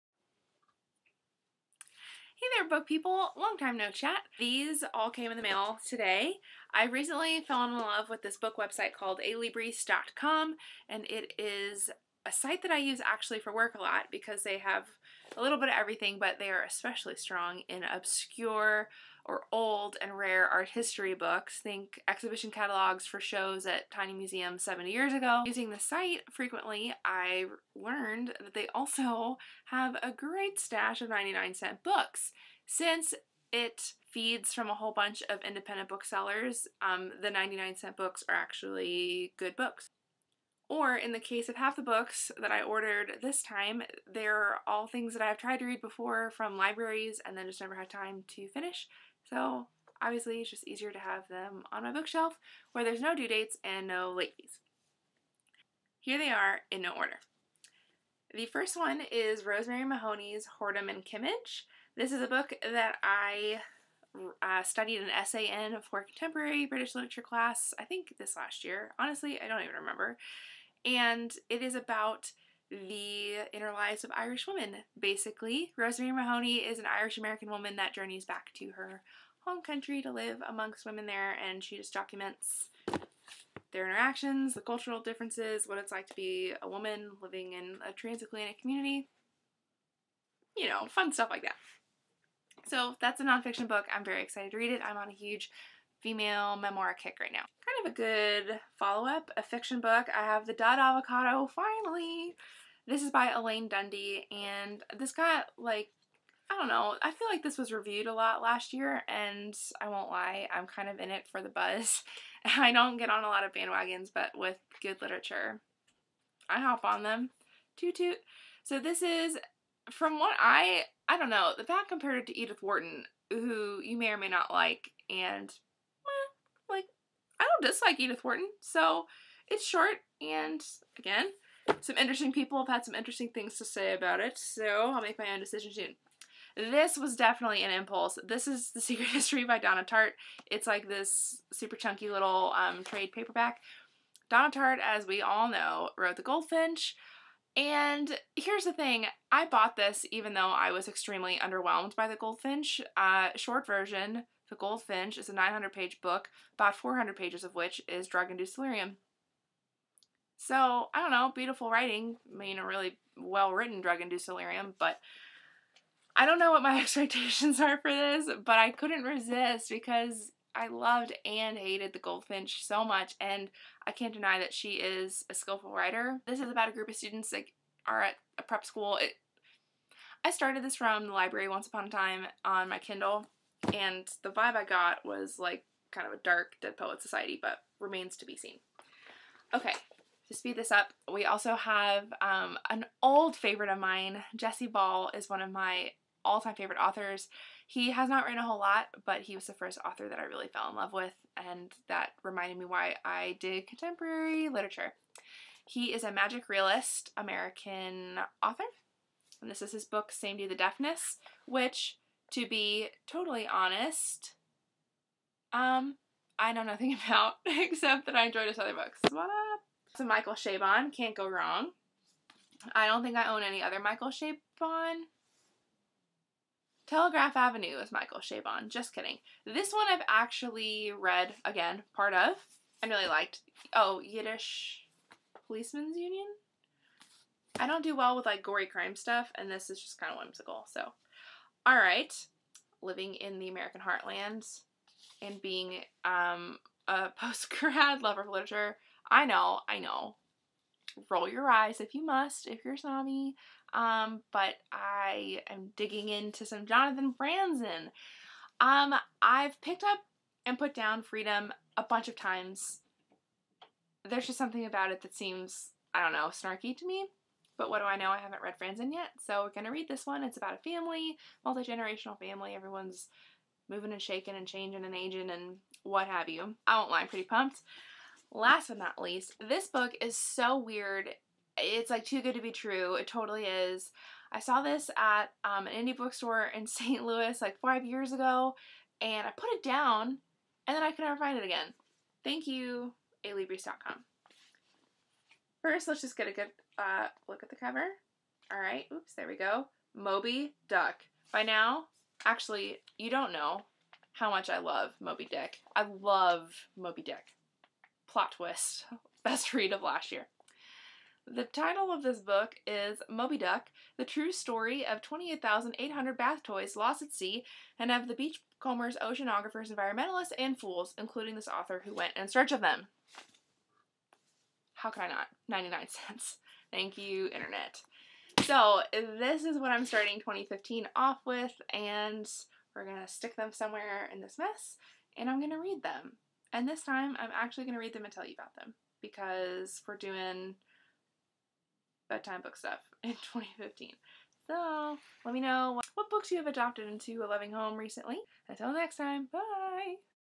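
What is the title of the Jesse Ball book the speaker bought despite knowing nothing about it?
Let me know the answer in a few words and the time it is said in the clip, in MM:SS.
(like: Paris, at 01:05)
Samedi the Deafness, at 03:30.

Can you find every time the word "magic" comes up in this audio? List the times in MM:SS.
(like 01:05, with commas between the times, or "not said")
03:26.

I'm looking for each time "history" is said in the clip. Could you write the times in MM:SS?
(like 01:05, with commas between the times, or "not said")
00:20, 02:19.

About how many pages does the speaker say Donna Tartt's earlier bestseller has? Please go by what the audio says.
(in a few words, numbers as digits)
900.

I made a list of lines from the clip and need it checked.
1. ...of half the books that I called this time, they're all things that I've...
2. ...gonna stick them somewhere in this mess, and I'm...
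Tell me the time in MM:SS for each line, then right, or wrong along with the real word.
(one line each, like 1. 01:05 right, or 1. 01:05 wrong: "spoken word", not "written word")
1. 00:41 wrong: "ordered", not "called"
2. 05:32 right.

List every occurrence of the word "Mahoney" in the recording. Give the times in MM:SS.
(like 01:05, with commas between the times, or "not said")
00:59, 01:16.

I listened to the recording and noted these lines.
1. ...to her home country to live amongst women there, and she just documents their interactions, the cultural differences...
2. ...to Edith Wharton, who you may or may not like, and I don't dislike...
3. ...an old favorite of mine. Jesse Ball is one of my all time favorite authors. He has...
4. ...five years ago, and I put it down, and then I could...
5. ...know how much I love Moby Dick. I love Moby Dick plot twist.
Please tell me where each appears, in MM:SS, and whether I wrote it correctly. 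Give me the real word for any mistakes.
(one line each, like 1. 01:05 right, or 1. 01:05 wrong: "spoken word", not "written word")
1. 01:18 right
2. 02:02 right
3. 03:12 right
4. 04:47 right
5. 05:03 right.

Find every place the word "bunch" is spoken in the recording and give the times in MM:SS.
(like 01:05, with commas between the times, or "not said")
00:34, 04:21.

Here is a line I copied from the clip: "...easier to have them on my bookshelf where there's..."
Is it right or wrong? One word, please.
right.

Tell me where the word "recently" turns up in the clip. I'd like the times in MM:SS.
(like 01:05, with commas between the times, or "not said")
00:06, 05:47.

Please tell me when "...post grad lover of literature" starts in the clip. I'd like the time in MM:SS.
04:07.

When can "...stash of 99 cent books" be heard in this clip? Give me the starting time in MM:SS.
00:30.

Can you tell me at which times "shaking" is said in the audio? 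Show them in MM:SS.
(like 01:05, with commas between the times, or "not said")
04:34.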